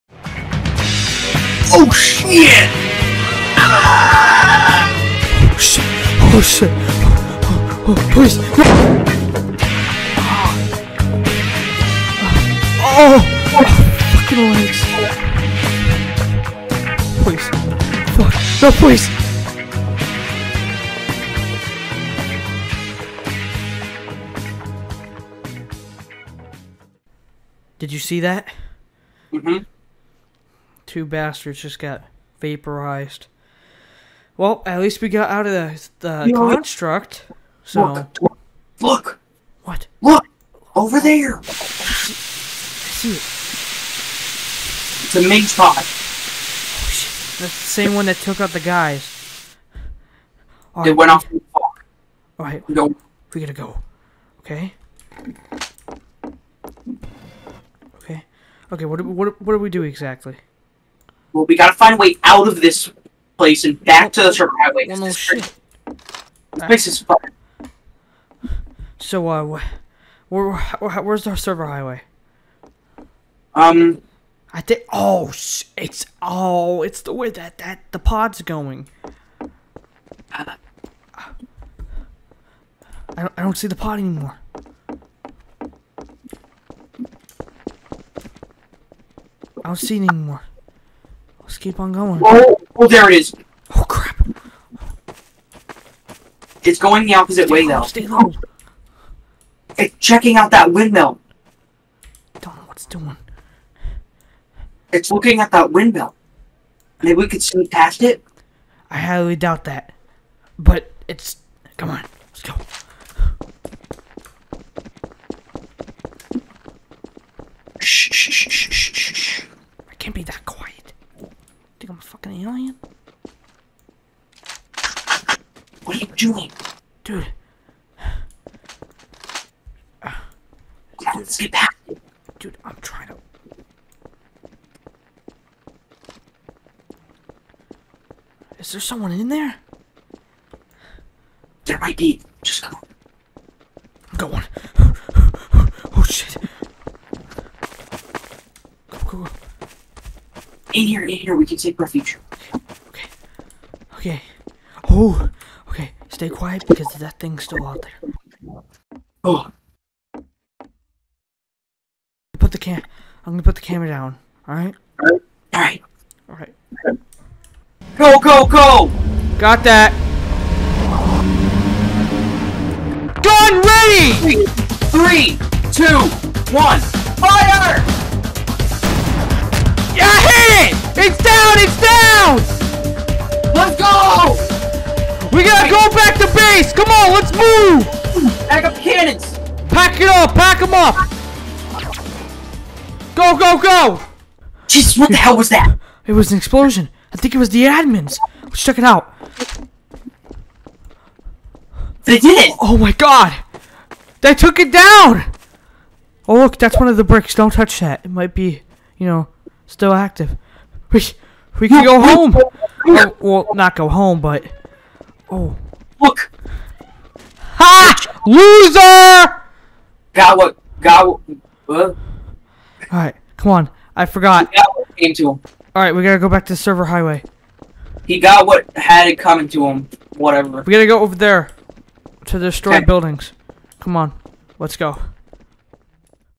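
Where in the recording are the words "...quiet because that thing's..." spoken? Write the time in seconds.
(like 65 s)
156 s.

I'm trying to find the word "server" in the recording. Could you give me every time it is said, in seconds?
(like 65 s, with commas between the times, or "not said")
64 s, 71 s, 226 s.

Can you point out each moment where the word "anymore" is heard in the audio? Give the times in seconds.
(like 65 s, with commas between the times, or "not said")
83 s, 90 s.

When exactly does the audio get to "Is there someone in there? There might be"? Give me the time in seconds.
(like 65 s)
138 s.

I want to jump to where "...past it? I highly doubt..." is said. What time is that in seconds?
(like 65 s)
107 s.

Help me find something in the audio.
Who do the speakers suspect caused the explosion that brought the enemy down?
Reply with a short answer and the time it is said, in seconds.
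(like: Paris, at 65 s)
the admins, at 197 s.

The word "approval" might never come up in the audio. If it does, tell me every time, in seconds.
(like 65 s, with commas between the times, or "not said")
not said.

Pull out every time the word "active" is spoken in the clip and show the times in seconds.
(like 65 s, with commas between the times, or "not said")
209 s.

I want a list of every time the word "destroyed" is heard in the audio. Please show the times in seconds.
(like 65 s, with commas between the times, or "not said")
232 s.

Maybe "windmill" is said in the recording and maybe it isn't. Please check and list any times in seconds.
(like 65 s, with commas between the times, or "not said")
100 s, 105 s.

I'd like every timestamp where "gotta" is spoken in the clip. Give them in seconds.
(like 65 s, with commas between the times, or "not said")
52 s, 61 s, 226 s, 230 s.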